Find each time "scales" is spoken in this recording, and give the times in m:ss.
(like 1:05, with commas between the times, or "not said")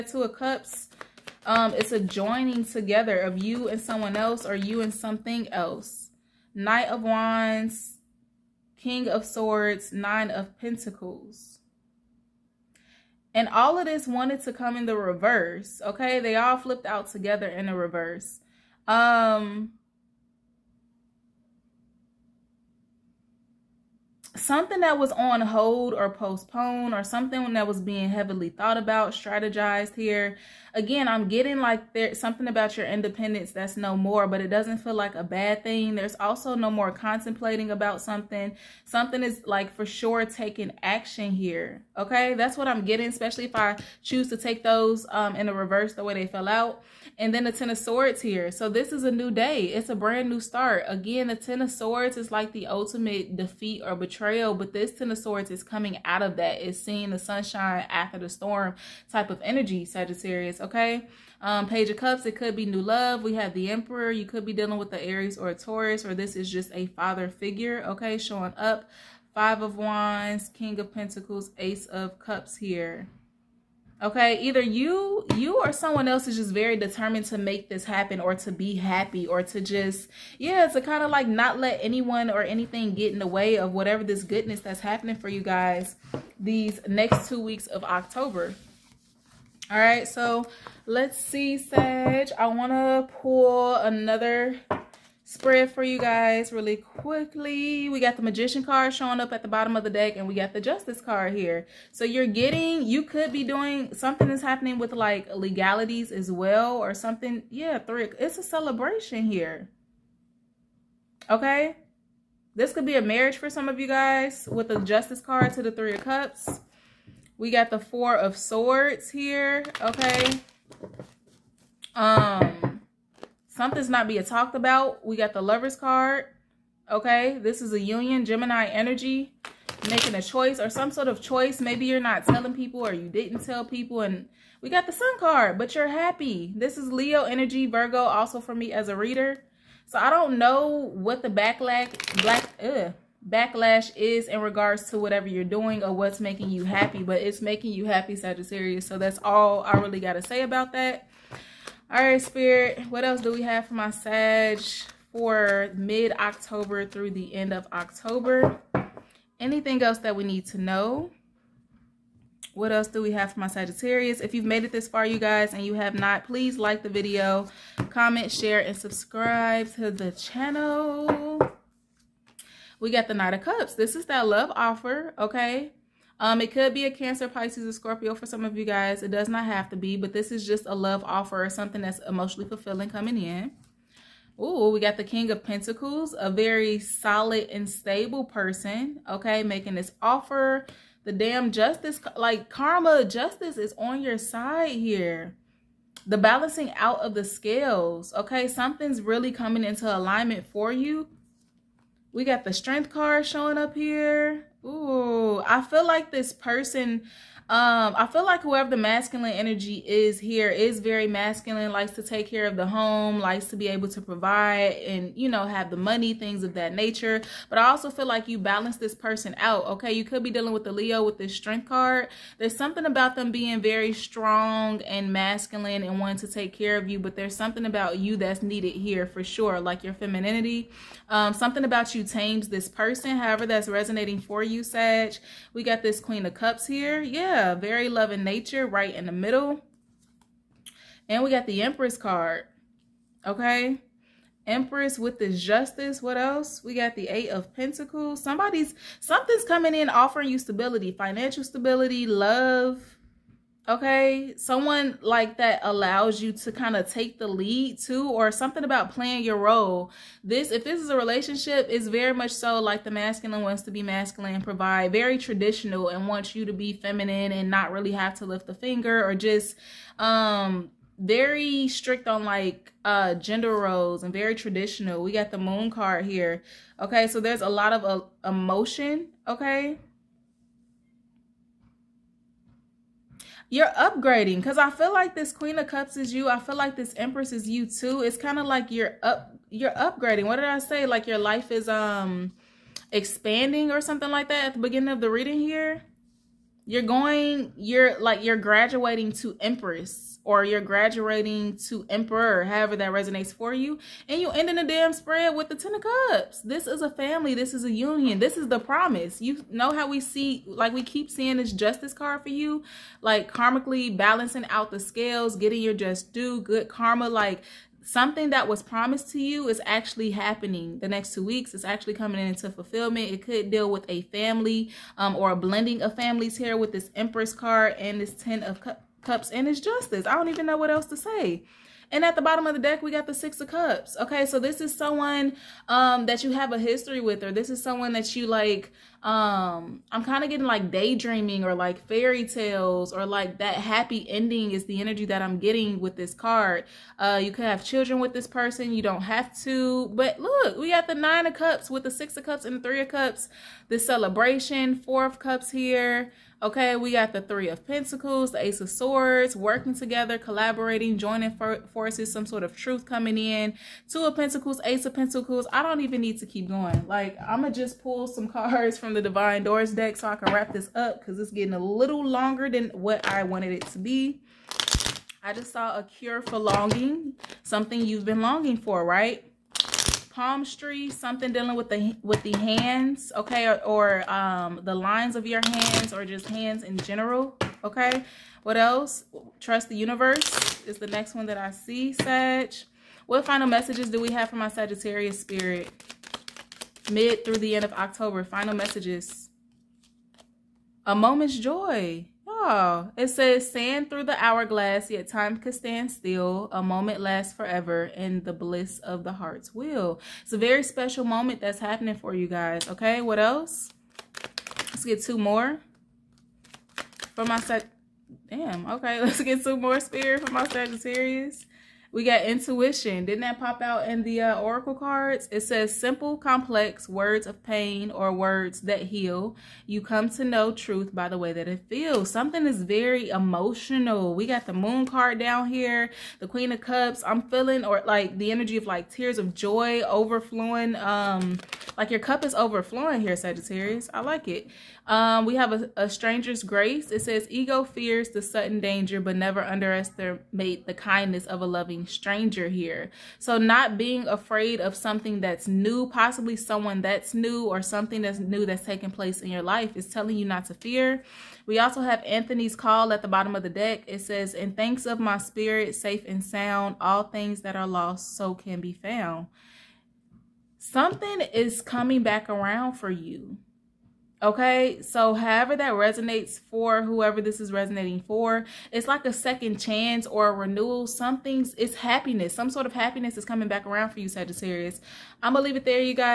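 3:17, 5:14.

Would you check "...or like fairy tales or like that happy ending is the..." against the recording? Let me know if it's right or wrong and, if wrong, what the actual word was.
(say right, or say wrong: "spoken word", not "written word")
right.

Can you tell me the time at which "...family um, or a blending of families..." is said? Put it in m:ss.
5:24.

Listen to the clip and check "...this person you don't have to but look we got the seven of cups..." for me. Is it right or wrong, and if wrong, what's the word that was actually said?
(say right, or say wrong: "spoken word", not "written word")
wrong: "nine", not "seven".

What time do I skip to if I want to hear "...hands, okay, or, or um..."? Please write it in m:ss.
6:22.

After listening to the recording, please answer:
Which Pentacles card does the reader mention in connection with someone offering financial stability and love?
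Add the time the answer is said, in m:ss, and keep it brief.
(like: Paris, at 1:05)
Eight of Pentacles, at 4:07.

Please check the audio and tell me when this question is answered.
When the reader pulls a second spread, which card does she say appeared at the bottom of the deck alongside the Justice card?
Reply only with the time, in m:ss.
1:38.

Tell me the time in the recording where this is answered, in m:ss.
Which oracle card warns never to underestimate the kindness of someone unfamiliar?
7:25.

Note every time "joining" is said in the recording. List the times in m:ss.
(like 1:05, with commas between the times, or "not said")
0:01, 6:00.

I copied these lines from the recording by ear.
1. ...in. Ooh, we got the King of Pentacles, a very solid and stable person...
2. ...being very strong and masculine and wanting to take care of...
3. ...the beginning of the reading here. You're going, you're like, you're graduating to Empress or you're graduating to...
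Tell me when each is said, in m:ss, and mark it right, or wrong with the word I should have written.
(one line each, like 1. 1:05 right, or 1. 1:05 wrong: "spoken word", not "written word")
1. 3:03 right
2. 3:43 right
3. 4:54 right.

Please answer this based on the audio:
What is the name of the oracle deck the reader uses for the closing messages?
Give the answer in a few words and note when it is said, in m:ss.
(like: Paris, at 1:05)
Divine Doors, at 6:09.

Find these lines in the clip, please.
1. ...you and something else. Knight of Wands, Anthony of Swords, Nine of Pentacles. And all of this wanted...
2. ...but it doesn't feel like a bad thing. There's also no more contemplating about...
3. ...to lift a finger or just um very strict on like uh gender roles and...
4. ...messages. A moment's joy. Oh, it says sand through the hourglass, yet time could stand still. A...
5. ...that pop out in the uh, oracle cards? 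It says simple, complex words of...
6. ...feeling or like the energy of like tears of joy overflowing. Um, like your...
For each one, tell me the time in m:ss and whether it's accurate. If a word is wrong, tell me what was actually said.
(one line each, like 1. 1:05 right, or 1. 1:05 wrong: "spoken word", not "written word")
1. 0:04 wrong: "King", not "Anthony"
2. 0:34 right
3. 4:28 right
4. 6:38 right
5. 7:03 right
6. 7:17 right.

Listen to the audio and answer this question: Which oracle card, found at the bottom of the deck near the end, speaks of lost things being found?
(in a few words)
Anthony's call.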